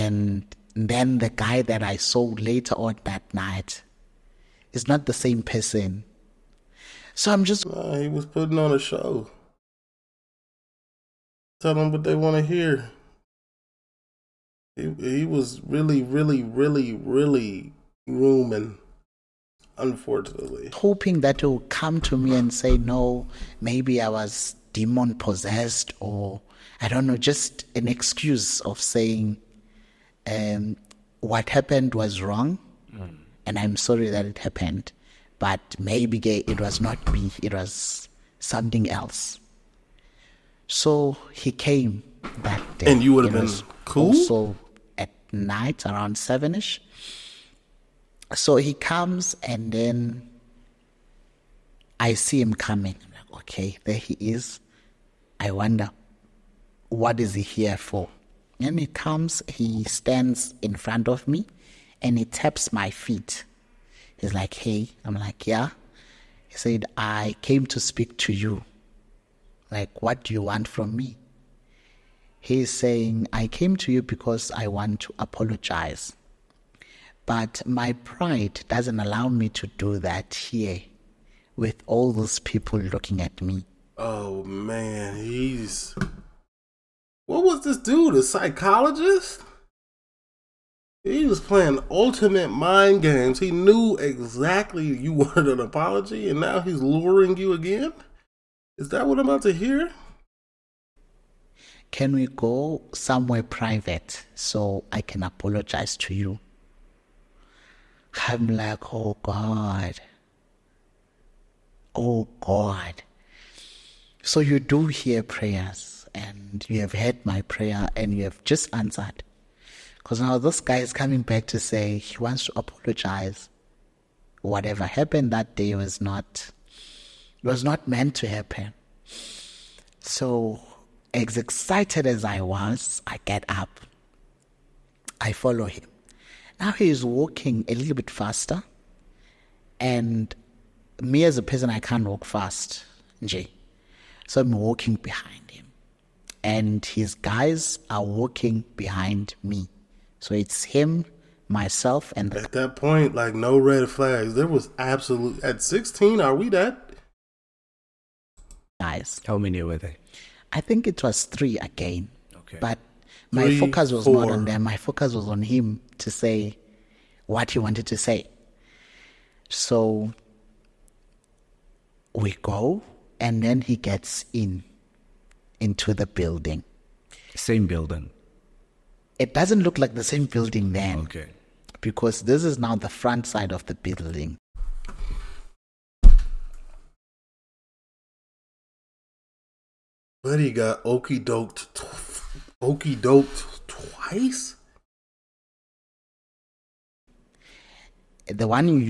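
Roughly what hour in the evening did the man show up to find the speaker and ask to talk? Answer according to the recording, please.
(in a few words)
7.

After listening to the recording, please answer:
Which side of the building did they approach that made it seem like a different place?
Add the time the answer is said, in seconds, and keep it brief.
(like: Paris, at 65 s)
front side, at 182 s.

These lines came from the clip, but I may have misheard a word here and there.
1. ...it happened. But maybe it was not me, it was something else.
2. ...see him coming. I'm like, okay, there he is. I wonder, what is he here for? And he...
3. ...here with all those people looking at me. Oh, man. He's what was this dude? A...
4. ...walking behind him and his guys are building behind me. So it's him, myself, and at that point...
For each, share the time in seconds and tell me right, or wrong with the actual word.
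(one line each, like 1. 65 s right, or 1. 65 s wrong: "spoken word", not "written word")
1. 34 s right
2. 52 s right
3. 80 s right
4. 144 s wrong: "walking", not "building".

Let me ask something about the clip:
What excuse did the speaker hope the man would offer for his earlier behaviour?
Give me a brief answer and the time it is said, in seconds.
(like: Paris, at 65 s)
demon possessed, at 24 s.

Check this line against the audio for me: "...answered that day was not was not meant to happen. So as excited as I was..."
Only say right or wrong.
wrong.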